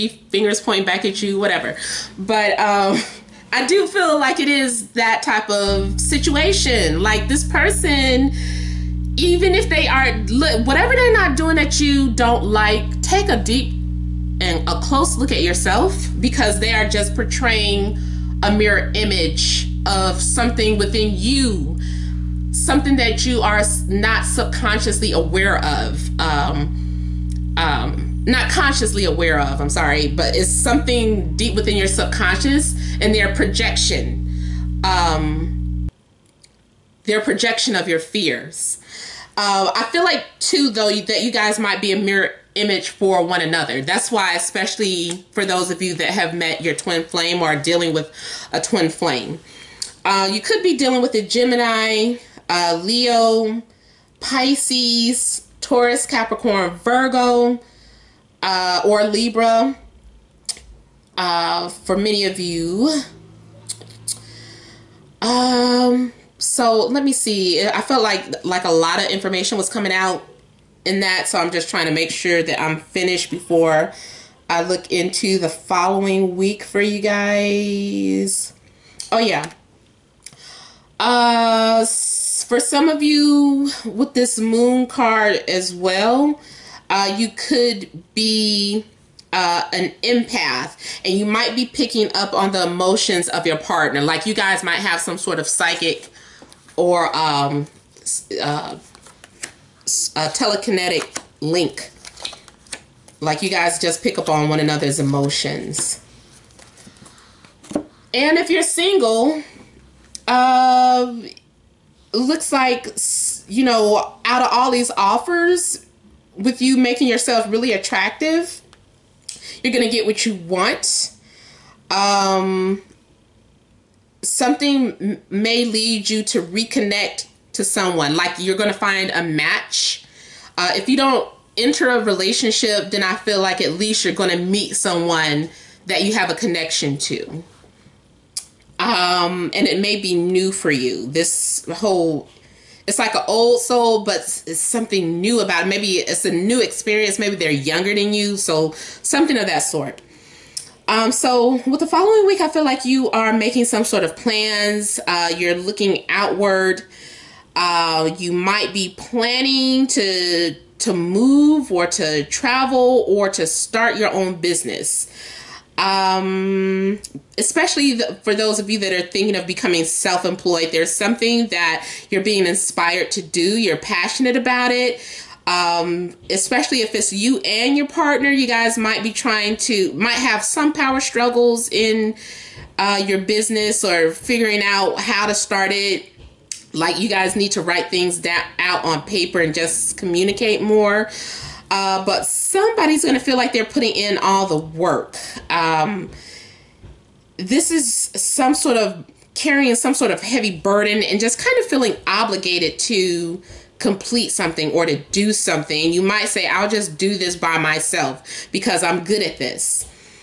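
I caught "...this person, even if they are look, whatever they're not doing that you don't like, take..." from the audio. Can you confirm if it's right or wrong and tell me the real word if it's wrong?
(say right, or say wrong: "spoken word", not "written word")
right.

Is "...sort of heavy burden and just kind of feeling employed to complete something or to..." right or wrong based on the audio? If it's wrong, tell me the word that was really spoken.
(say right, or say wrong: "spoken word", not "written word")
wrong: "obligated", not "employed".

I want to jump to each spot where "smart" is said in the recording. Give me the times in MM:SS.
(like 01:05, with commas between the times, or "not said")
not said.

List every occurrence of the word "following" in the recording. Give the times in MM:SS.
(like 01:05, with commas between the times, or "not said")
01:15, 02:31.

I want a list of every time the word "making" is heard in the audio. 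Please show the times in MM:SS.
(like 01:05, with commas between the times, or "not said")
01:56, 02:33.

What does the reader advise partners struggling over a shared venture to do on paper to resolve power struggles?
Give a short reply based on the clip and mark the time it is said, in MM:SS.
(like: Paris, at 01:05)
Write things down, at 03:07.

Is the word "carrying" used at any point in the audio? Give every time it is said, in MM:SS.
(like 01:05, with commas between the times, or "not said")
03:19.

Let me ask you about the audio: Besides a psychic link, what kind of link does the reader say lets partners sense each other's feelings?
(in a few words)
Telekinetic.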